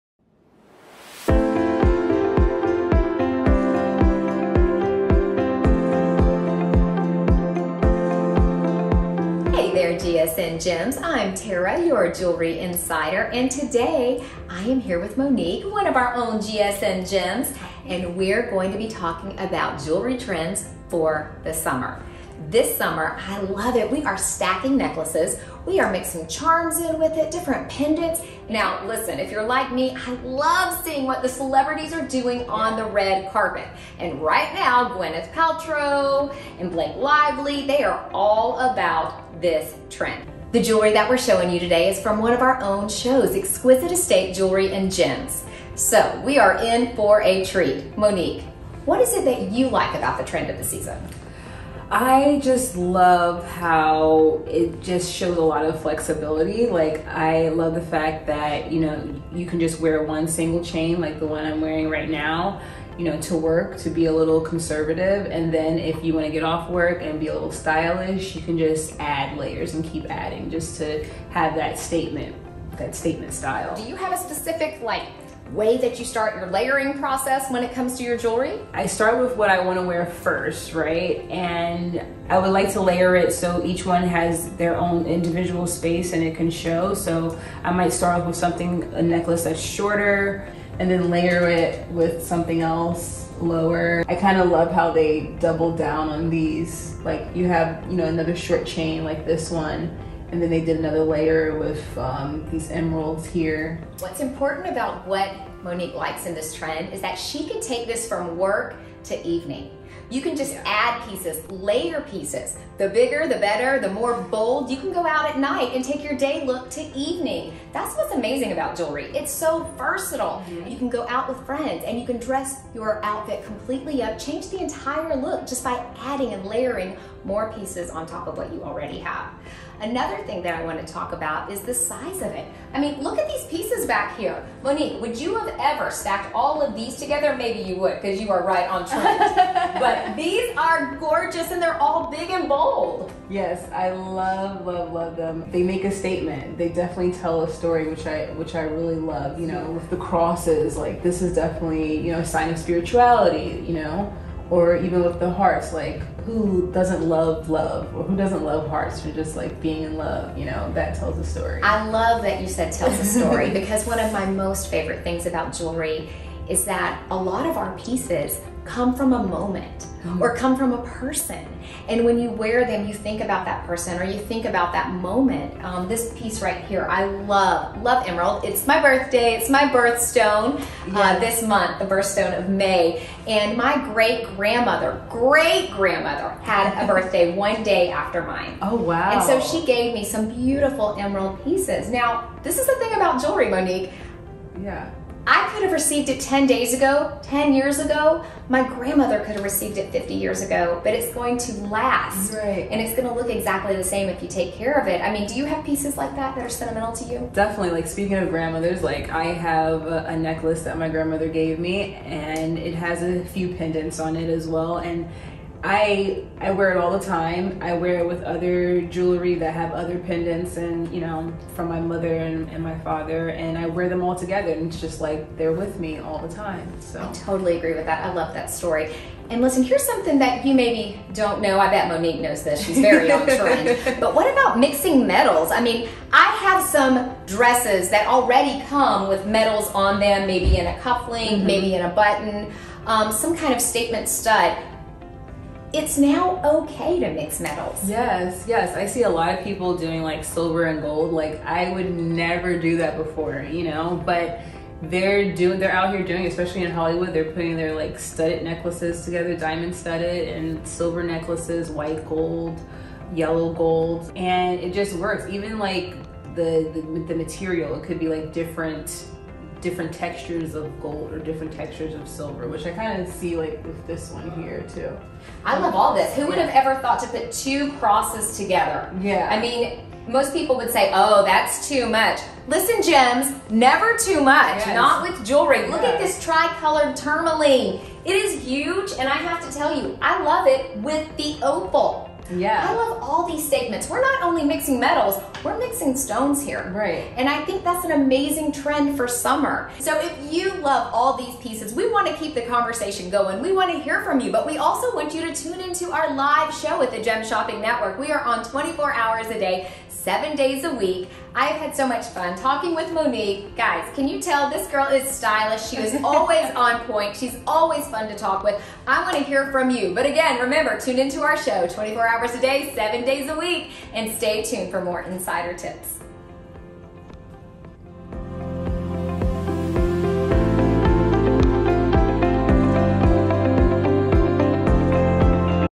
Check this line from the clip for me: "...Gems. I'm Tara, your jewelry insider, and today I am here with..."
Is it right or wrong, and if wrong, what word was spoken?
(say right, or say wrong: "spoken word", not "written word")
right.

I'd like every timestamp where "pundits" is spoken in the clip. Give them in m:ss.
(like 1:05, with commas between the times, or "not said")
not said.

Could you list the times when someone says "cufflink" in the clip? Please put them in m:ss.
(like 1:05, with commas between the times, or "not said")
4:00.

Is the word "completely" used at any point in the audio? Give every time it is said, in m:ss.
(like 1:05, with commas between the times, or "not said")
2:03.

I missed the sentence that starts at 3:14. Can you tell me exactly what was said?
Yeah I could have received it 10 days ago, 10 years ago.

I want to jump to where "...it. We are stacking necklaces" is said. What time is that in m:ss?
0:23.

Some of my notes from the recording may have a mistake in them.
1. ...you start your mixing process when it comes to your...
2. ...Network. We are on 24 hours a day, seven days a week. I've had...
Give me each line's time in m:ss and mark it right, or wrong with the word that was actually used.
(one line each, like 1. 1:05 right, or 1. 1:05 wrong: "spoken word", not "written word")
1. 1:15 wrong: "layering", not "mixing"
2. 5:07 right.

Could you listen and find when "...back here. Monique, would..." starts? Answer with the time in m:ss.
2:13.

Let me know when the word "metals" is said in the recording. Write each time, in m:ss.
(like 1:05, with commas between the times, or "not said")
3:55, 3:59, 4:07, 4:54.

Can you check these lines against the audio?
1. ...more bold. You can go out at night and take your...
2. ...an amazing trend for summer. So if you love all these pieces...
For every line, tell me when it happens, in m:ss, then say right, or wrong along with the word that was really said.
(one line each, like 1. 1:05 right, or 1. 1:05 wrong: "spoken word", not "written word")
1. 1:53 right
2. 4:57 right.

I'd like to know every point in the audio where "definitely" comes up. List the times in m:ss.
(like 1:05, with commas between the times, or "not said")
2:26, 2:31, 3:27.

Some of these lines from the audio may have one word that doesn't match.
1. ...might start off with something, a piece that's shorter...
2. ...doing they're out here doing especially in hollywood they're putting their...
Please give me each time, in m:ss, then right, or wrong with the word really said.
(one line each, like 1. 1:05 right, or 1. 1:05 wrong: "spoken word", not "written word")
1. 1:27 wrong: "necklace", not "piece"
2. 4:15 right.